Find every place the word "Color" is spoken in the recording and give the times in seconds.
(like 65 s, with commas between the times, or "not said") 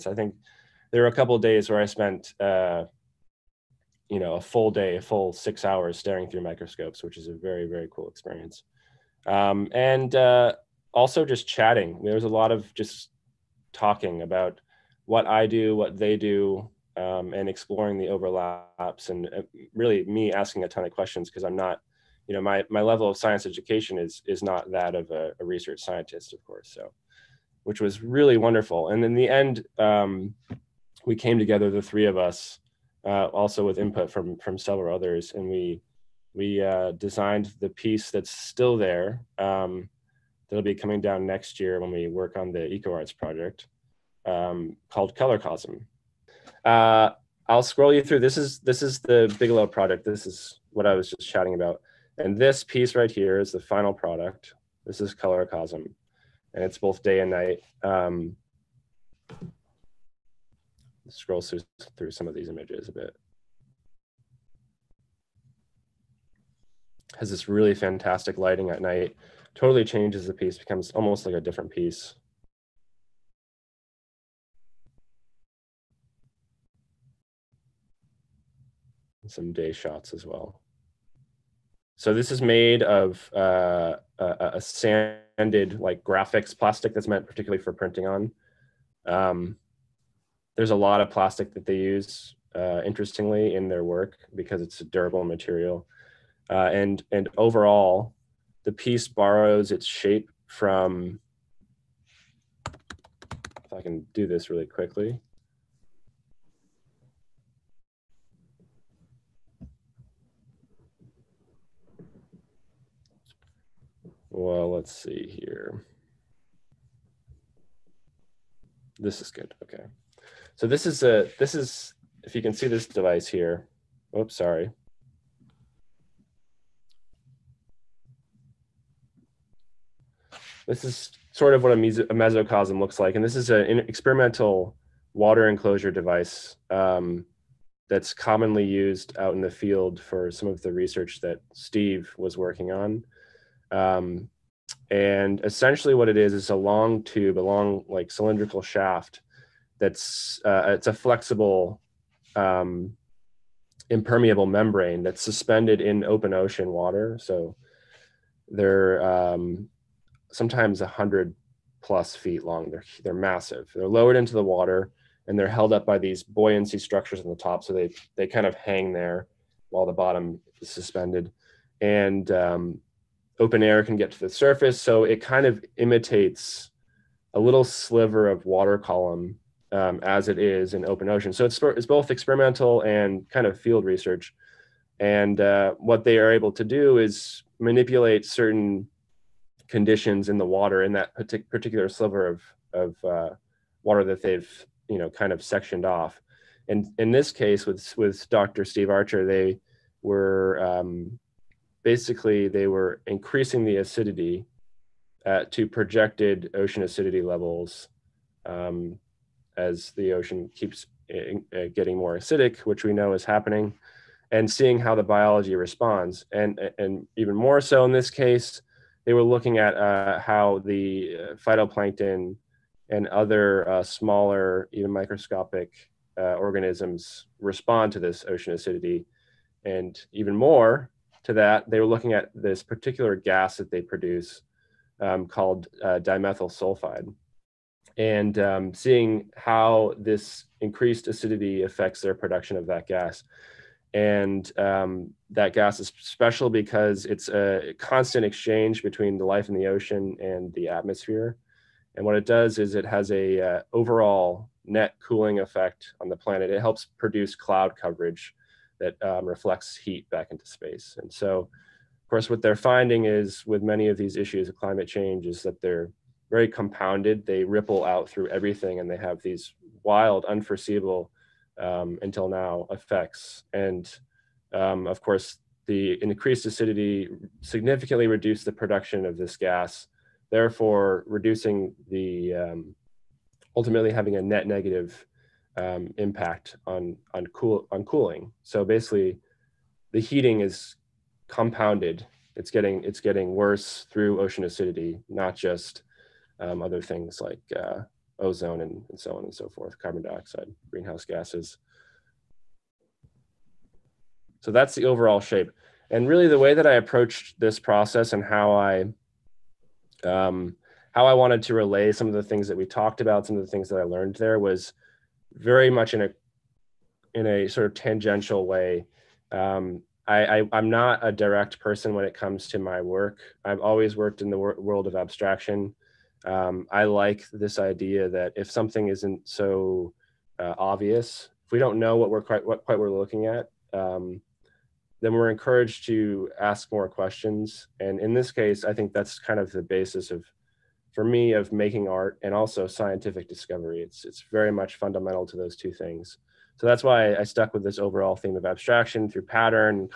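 45 s, 55 s.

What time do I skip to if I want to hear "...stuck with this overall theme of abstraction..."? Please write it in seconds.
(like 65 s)
347 s.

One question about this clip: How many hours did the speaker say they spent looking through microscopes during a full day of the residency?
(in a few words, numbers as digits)
6.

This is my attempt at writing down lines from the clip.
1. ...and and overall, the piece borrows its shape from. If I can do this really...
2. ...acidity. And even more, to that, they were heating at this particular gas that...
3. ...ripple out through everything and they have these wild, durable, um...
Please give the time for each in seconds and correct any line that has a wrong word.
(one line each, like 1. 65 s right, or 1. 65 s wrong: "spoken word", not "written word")
1. 96 s right
2. 228 s wrong: "looking", not "heating"
3. 267 s wrong: "unforeseeable", not "durable".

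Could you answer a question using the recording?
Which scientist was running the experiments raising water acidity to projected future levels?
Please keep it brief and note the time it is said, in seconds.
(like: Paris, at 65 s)
Dr. Steve Archer, at 198 s.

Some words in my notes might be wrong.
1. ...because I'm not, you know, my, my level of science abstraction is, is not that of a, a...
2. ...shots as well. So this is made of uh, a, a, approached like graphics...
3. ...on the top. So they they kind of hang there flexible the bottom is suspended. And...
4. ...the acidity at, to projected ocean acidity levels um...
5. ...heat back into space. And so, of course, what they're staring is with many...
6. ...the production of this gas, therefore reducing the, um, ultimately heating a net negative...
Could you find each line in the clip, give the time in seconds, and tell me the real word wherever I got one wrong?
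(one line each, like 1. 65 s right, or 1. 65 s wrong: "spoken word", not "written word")
1. 21 s wrong: "education", not "abstraction"
2. 79 s wrong: "sanded", not "approached"
3. 167 s wrong: "while", not "flexible"
4. 203 s right
5. 259 s wrong: "finding", not "staring"
6. 278 s wrong: "having", not "heating".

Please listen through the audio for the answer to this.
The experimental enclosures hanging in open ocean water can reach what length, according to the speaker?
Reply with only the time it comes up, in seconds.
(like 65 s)
160 s.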